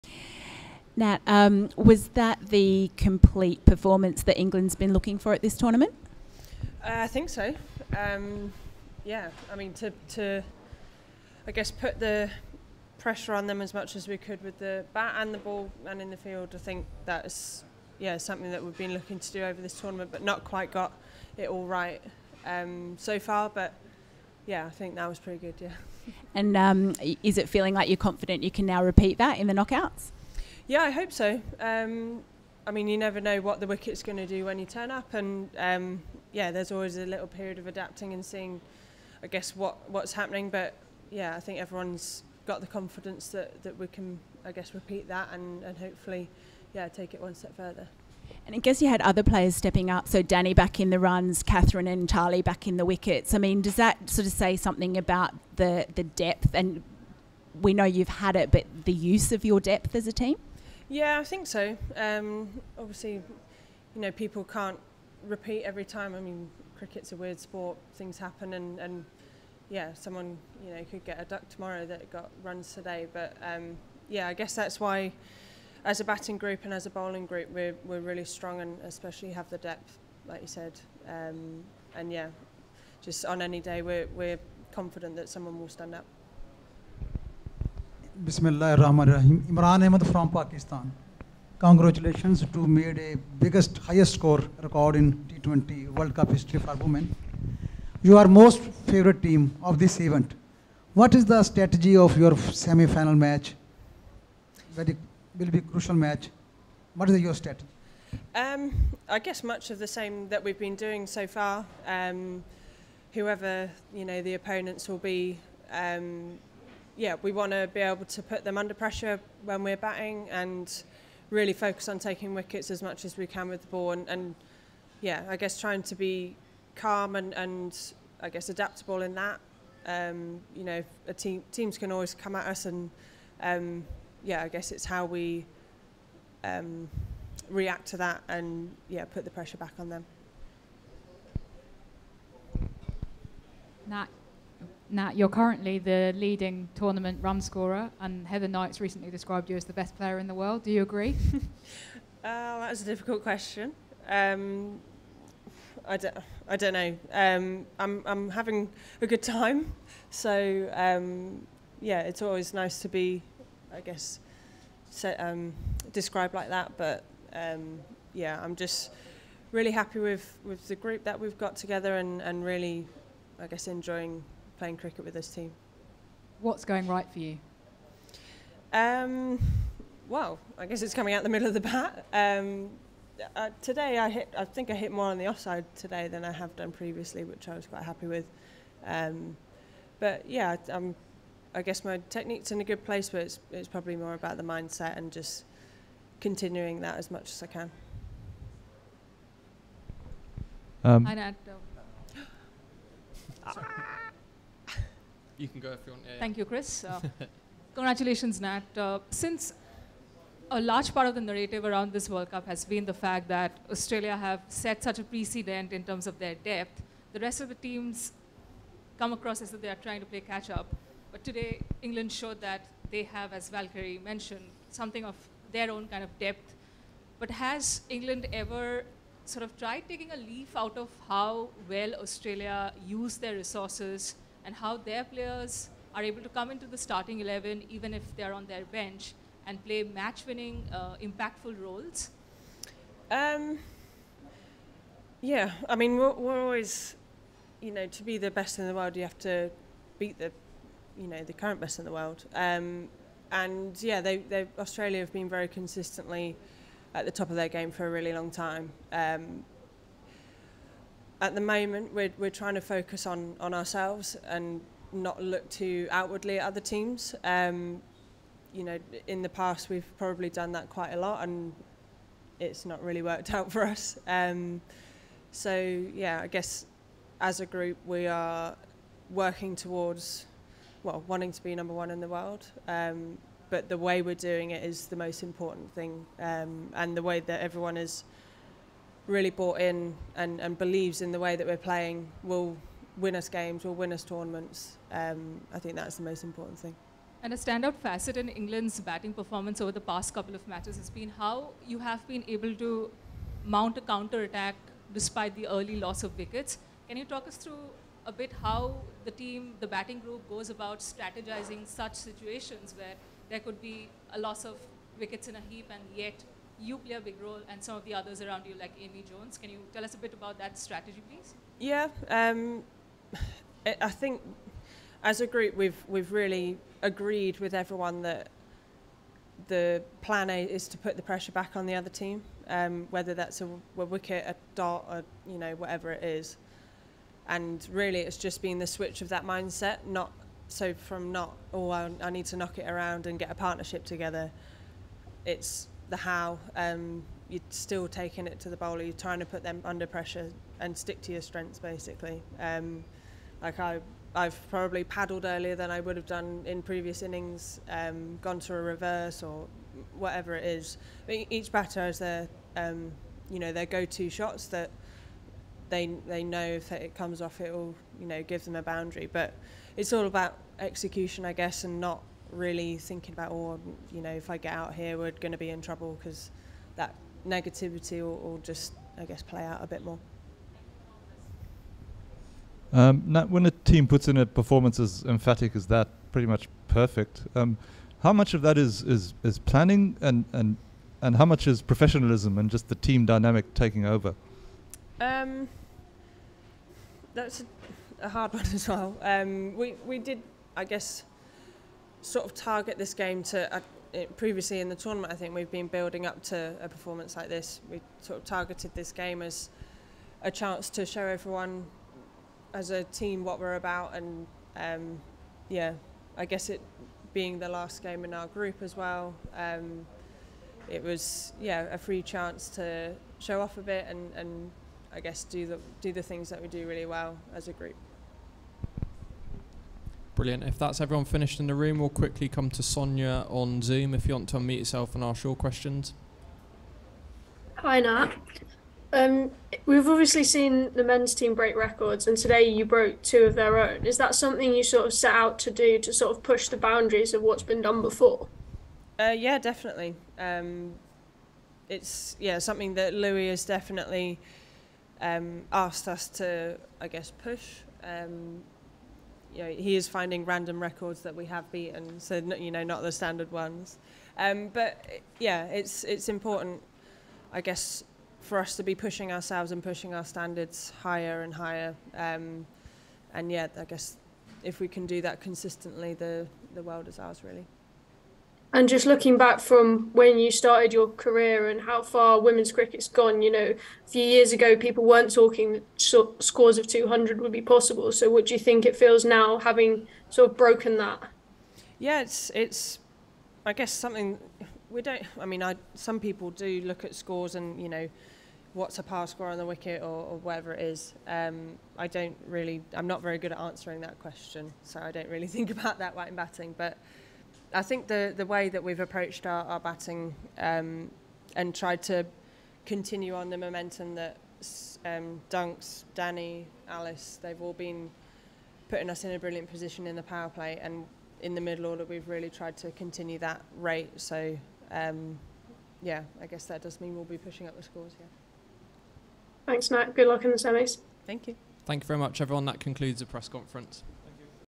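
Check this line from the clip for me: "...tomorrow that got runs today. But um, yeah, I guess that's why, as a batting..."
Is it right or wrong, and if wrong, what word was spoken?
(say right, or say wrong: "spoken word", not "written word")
right.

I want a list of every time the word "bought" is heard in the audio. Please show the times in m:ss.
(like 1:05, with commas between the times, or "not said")
4:49.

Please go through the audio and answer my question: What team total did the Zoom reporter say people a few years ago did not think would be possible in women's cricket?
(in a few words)
200.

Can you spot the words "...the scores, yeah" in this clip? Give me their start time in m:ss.
8:47.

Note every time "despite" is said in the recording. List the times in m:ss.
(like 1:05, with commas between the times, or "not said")
5:04.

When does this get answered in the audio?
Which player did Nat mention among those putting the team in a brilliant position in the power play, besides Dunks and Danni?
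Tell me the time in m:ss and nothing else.
8:36.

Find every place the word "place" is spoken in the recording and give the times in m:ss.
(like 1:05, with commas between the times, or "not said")
3:12.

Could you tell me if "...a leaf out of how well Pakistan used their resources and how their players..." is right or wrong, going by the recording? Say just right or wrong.
wrong.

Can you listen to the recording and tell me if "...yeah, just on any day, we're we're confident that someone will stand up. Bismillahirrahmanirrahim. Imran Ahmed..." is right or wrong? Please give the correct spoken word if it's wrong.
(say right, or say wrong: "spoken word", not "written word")
right.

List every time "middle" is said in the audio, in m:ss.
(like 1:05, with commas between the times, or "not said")
3:01, 8:41.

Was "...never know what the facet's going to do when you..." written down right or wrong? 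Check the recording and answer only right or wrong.
wrong.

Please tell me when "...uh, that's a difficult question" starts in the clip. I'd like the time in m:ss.
2:32.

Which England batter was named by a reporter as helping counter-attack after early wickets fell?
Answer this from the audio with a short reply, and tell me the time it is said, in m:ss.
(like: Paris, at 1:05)
Amy Jones, at 5:18.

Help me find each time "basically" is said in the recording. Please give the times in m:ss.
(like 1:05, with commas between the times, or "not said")
5:51.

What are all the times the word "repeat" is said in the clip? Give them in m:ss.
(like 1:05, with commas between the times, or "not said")
0:28, 0:44, 1:05.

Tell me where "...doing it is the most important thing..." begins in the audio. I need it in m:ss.
4:44.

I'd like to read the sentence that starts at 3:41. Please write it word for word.
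But today, England showed that they have, as Valkyrie mentioned, something of their own kind of depth.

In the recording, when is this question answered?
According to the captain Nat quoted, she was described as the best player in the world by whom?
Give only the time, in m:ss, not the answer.
2:28.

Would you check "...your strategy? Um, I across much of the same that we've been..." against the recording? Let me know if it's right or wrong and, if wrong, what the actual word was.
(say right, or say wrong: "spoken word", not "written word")
wrong: "guess", not "across".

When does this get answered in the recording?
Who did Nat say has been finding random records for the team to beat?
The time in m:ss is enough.
7:32.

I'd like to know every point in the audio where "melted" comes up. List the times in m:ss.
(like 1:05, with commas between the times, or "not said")
not said.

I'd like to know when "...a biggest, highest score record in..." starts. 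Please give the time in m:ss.
1:32.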